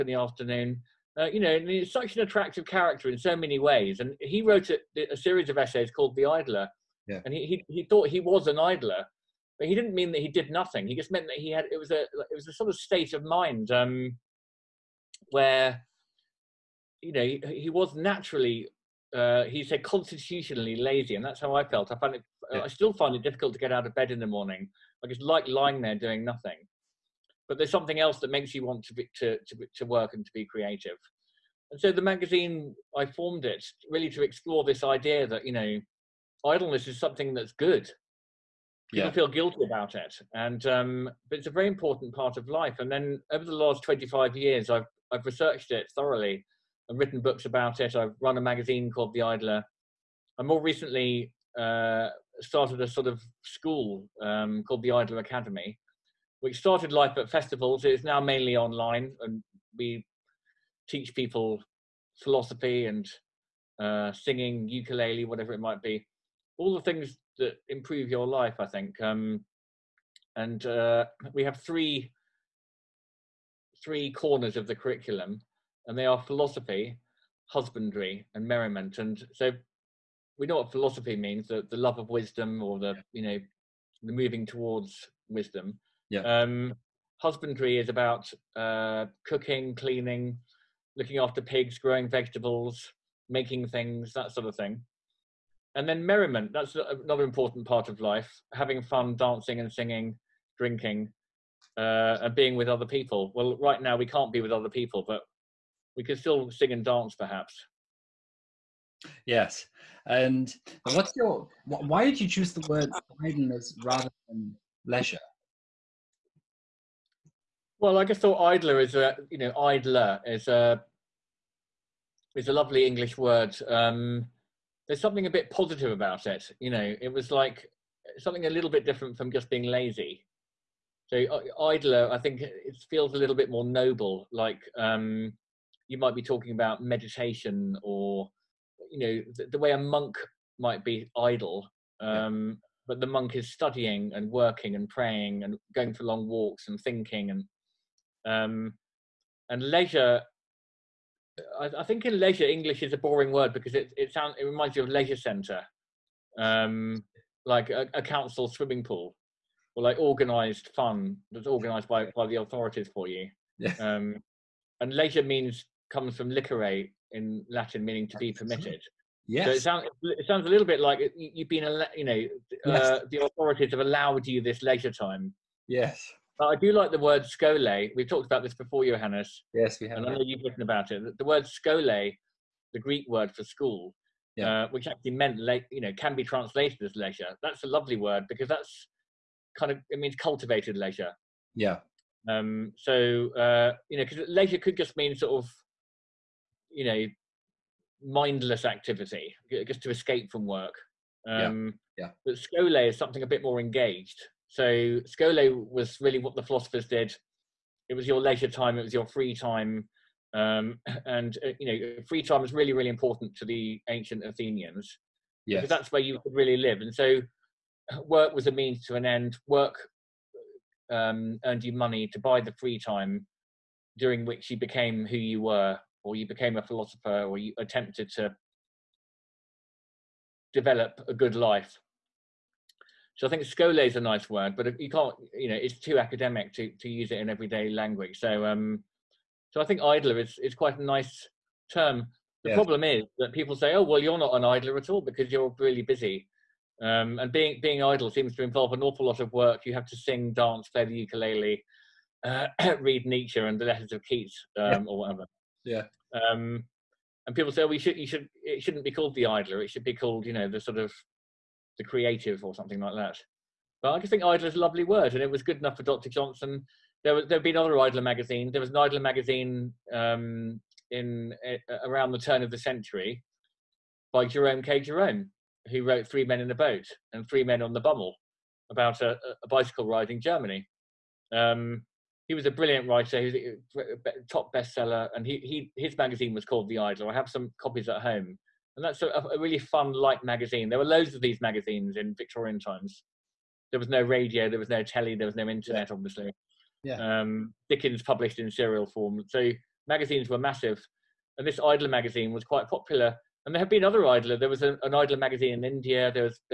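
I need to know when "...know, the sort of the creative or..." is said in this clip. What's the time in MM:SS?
04:20.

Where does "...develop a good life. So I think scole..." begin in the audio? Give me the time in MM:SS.
03:50.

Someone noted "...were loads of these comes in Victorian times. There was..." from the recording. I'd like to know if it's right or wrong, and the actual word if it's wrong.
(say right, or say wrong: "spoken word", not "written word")
wrong: "magazines", not "comes".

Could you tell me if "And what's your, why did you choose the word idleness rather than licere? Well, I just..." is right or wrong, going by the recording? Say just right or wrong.
wrong.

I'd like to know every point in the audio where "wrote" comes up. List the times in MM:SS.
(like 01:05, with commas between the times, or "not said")
00:04, 04:35.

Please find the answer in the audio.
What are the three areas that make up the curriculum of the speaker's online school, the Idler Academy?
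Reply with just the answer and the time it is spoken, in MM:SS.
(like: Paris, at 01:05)
Philosophy, husbandry, and merriment, at 01:16.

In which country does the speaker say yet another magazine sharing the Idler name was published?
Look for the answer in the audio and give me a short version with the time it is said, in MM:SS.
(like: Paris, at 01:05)
India, at 05:05.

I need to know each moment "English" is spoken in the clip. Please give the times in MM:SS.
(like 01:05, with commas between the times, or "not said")
02:02, 02:32.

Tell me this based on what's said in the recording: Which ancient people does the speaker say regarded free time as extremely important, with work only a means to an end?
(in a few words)
The ancient Athenians.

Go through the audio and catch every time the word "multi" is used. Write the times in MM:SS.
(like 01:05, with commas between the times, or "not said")
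not said.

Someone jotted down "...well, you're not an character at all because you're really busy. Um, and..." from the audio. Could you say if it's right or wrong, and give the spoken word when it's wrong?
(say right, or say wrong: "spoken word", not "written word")
wrong: "idler", not "character".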